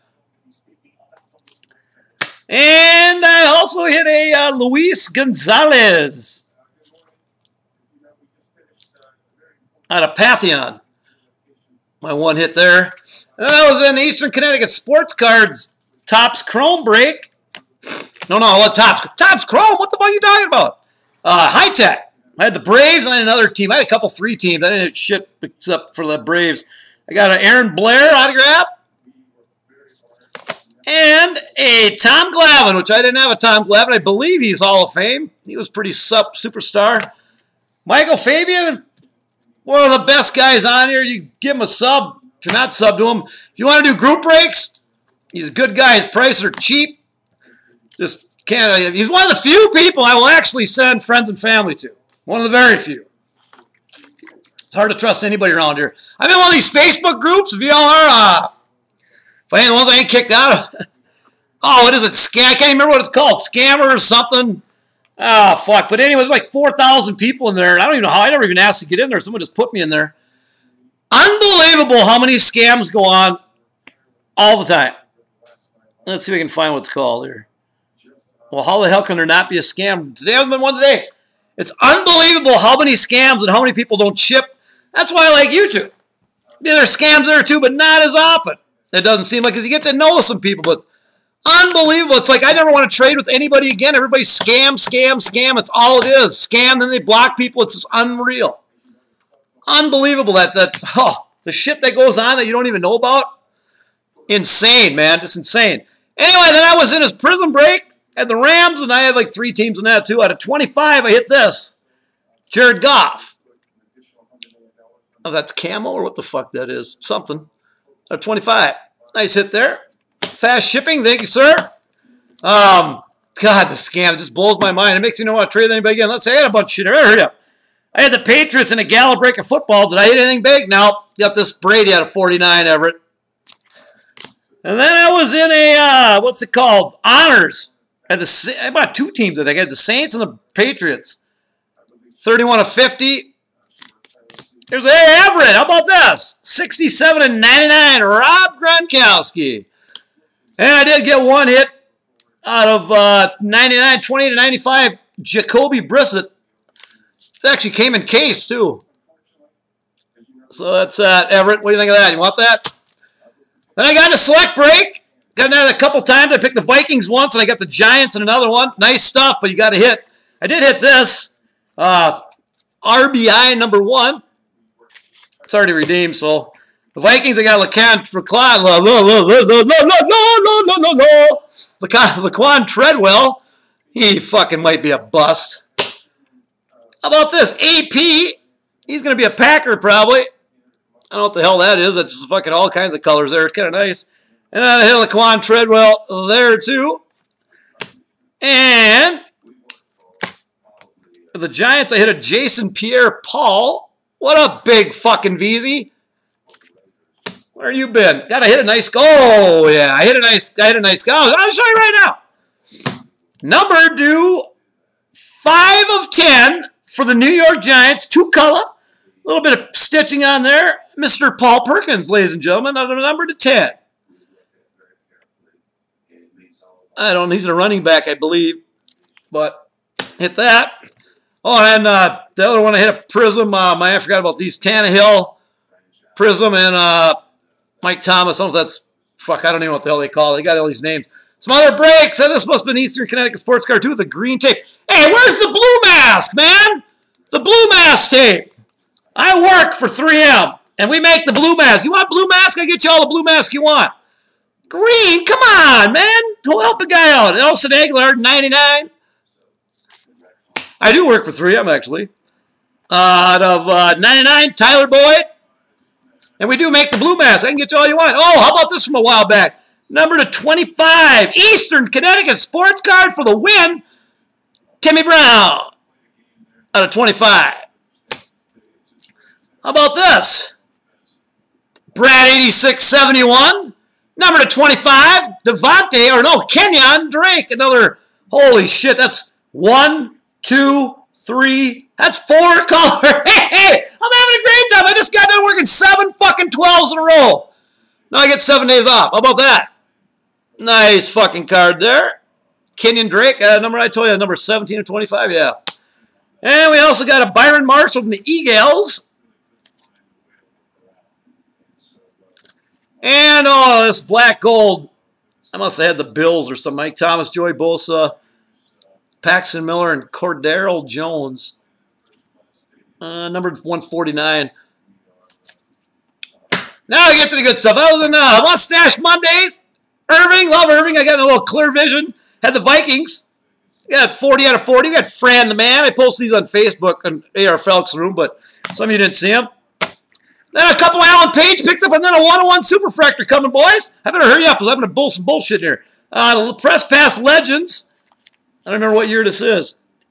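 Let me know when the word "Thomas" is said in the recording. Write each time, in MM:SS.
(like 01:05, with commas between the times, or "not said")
03:58, 05:16.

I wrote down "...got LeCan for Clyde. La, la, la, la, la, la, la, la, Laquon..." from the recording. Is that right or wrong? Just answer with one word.
right.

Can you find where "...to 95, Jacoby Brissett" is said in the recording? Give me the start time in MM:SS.
02:34.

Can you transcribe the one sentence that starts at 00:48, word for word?
He's one of the few people I will actually send friends and family to.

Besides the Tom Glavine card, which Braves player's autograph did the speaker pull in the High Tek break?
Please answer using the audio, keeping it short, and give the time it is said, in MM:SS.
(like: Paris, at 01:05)
Aaron Blair, at 00:27.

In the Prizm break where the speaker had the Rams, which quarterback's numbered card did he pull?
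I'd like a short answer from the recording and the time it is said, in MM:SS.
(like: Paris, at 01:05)
Jared Goff, at 01:52.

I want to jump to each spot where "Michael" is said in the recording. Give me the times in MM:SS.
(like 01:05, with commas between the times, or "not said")
00:37.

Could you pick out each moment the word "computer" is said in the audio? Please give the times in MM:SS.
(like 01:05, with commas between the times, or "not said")
not said.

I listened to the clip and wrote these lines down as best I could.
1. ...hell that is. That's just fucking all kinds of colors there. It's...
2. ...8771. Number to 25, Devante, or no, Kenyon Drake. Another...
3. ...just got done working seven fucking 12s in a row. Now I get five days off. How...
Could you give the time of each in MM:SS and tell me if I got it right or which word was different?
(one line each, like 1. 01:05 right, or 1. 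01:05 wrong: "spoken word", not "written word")
1. 03:11 right
2. 04:42 wrong: "8671", not "8771"
3. 04:54 wrong: "seven", not "five".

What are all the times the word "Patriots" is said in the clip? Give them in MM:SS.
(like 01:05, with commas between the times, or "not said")
02:08, 02:20.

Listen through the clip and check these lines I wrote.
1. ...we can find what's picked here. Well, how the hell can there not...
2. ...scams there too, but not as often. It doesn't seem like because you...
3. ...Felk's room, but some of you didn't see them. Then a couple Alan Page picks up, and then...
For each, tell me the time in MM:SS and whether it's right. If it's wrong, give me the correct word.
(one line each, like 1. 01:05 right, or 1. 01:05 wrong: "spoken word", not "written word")
1. 01:16 wrong: "called", not "picked"
2. 01:26 right
3. 05:37 right.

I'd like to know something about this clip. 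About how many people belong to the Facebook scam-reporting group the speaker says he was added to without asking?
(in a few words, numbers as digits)
4000.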